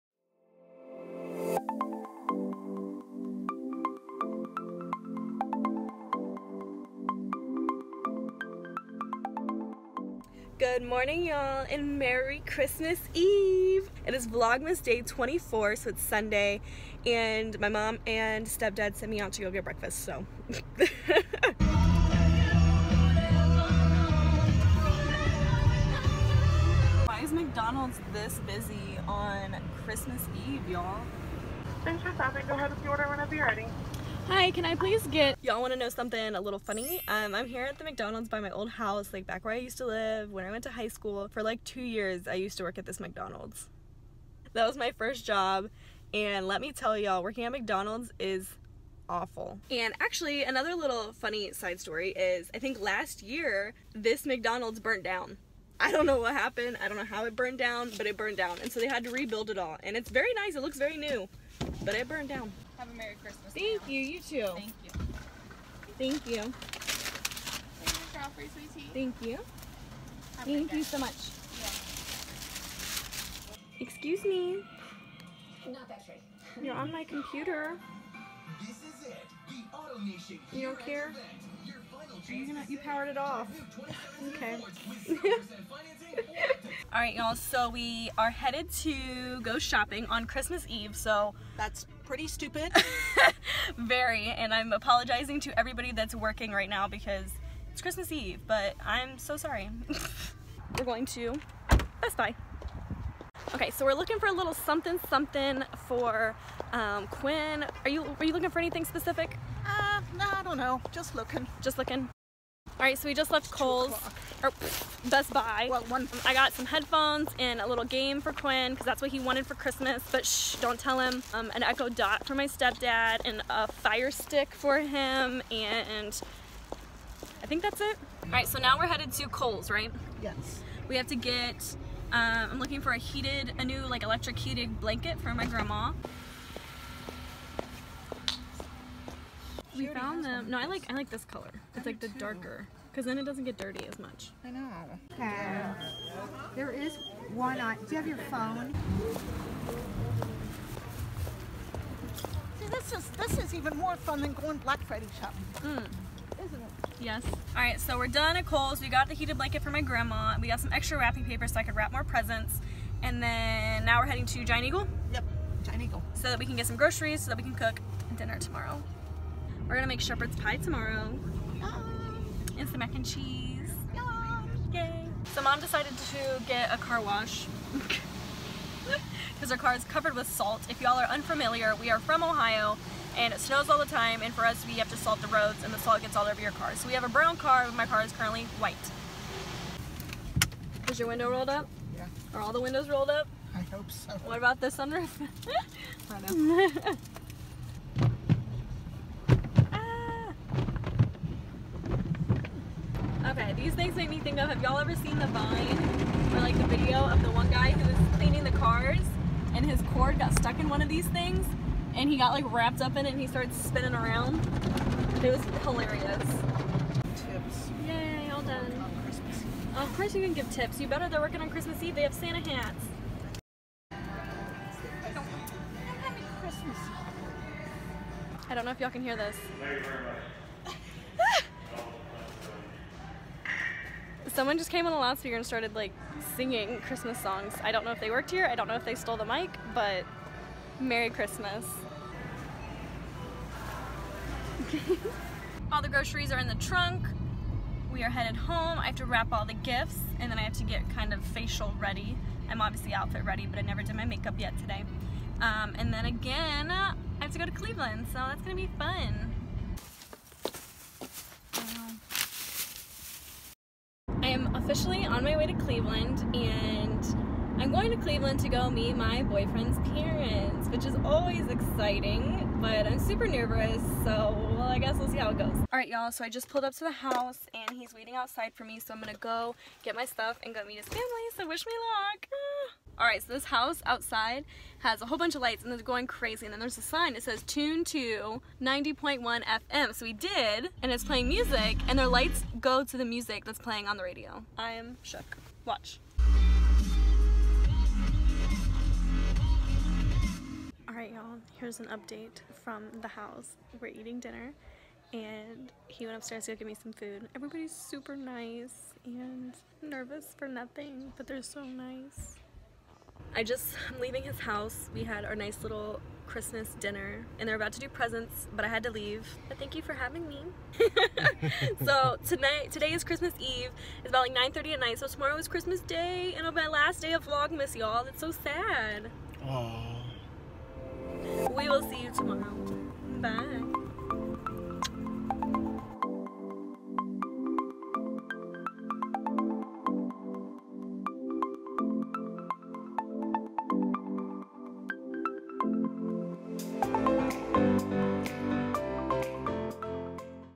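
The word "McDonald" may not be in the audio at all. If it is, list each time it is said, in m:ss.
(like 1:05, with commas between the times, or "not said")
0:27, 0:37, 0:42, 0:47, 0:54.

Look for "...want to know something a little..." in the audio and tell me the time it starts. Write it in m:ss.
0:35.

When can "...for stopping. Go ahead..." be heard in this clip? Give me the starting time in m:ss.
0:32.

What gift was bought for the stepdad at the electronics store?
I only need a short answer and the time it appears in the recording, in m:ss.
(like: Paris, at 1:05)
Echo Dot, at 2:01.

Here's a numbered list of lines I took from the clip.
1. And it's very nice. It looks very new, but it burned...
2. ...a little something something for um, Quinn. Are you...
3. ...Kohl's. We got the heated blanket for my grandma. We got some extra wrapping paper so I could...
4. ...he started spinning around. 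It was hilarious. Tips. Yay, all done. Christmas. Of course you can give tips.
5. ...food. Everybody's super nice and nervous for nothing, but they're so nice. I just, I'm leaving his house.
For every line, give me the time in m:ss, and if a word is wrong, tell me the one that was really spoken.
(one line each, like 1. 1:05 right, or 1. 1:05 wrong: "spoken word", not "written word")
1. 0:59 right
2. 1:44 right
3. 2:38 right
4. 3:33 right
5. 5:06 right.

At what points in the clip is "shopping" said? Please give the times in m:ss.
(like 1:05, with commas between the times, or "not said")
1:29, 2:35.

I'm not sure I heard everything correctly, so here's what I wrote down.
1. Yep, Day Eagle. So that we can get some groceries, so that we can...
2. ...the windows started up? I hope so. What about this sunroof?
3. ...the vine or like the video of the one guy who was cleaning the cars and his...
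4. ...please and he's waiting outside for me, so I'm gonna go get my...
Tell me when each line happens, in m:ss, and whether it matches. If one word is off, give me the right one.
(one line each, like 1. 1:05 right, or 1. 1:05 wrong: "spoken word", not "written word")
1. 2:45 wrong: "Giant", not "Day"
2. 3:12 wrong: "rolled", not "started"
3. 3:25 right
4. 4:36 wrong: "house", not "please".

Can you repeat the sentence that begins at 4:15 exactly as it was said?
Um, and then again, I have to go to Cleveland, so that's gonna be fun.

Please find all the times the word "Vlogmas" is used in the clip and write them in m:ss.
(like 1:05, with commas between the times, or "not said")
0:14, 5:27.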